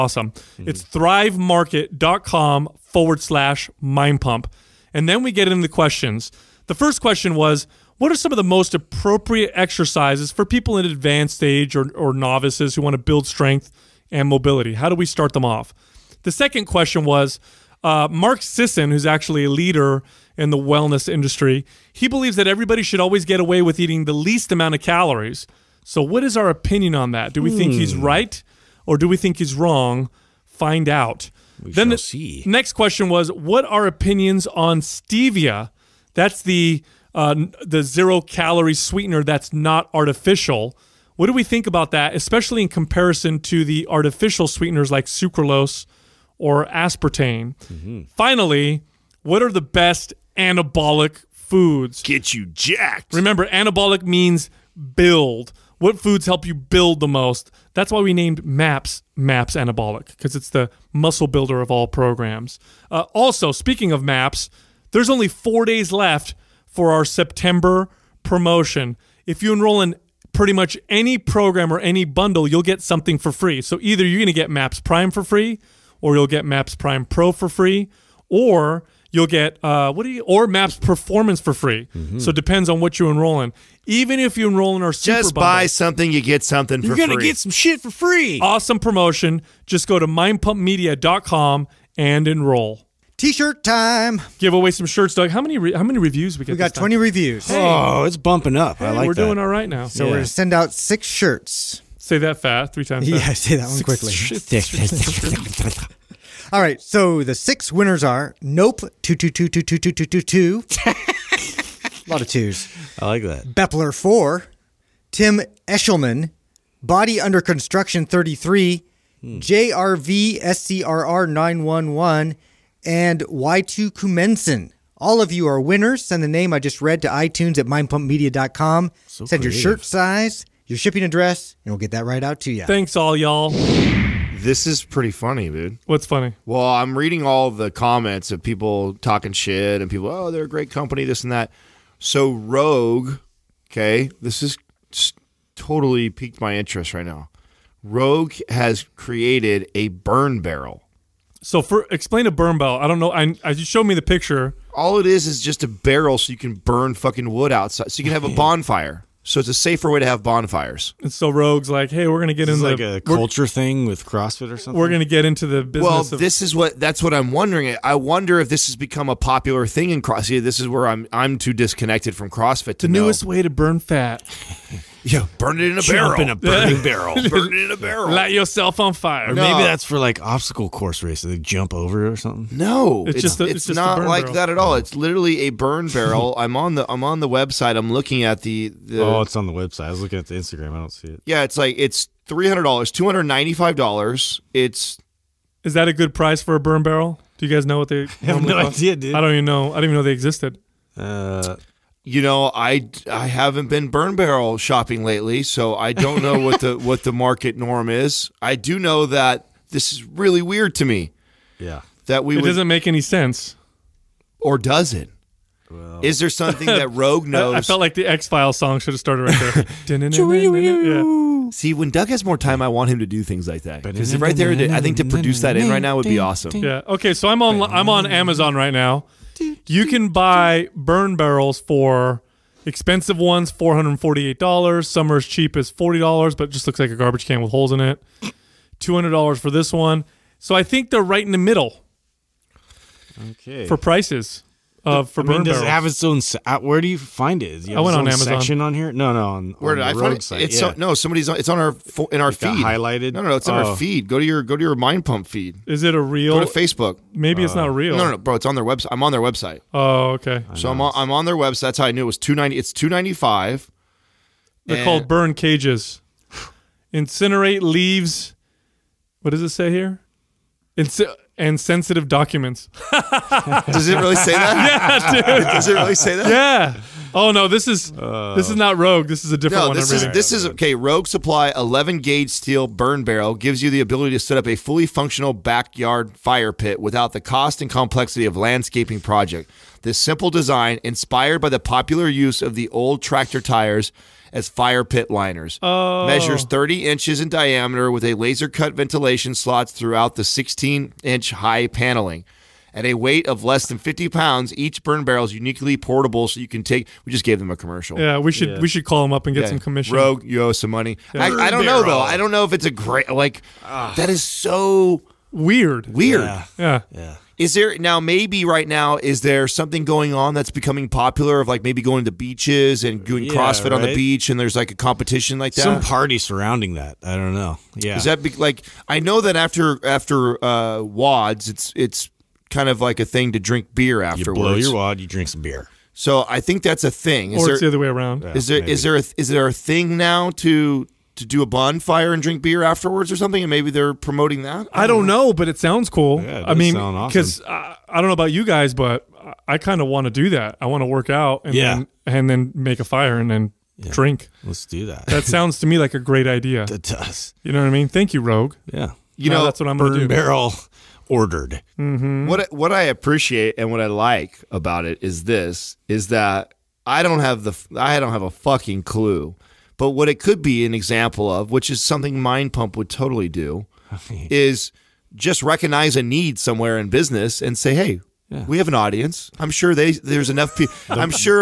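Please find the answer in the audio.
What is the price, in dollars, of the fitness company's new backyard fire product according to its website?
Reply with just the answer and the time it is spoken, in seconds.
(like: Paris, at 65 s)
$295, at 192 s.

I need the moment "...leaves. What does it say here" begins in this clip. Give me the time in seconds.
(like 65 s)
267 s.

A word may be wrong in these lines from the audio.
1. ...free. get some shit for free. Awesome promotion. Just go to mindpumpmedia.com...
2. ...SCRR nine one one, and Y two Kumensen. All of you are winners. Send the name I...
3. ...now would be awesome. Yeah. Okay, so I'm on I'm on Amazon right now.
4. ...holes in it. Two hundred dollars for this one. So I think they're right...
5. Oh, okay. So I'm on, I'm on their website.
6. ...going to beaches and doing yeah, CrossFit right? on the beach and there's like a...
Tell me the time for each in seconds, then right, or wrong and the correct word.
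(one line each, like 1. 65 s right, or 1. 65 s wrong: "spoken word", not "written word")
1. 87 s right
2. 120 s right
3. 225 s right
4. 237 s right
5. 259 s right
6. 321 s right.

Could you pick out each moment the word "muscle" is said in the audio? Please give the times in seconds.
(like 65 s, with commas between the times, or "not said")
60 s.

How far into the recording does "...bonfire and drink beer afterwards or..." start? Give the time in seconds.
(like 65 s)
341 s.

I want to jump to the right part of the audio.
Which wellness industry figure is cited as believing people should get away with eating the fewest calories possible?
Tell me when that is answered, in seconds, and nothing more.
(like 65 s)
18 s.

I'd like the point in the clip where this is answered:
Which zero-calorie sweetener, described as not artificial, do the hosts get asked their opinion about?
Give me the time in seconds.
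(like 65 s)
34 s.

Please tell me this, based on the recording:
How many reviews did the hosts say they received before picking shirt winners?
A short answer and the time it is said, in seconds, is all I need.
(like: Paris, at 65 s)
20, at 96 s.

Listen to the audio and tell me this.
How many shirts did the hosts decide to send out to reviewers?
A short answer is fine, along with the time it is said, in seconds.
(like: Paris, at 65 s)
6, at 100 s.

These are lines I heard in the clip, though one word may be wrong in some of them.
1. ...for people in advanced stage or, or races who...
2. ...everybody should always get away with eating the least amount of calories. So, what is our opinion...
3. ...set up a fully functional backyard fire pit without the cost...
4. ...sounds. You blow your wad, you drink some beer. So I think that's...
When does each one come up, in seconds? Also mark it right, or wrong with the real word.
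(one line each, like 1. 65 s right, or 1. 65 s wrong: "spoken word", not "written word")
1. 10 s wrong: "novices", not "races"
2. 22 s right
3. 284 s right
4. 334 s wrong: "afterwards", not "sounds".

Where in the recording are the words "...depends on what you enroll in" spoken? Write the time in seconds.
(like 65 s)
82 s.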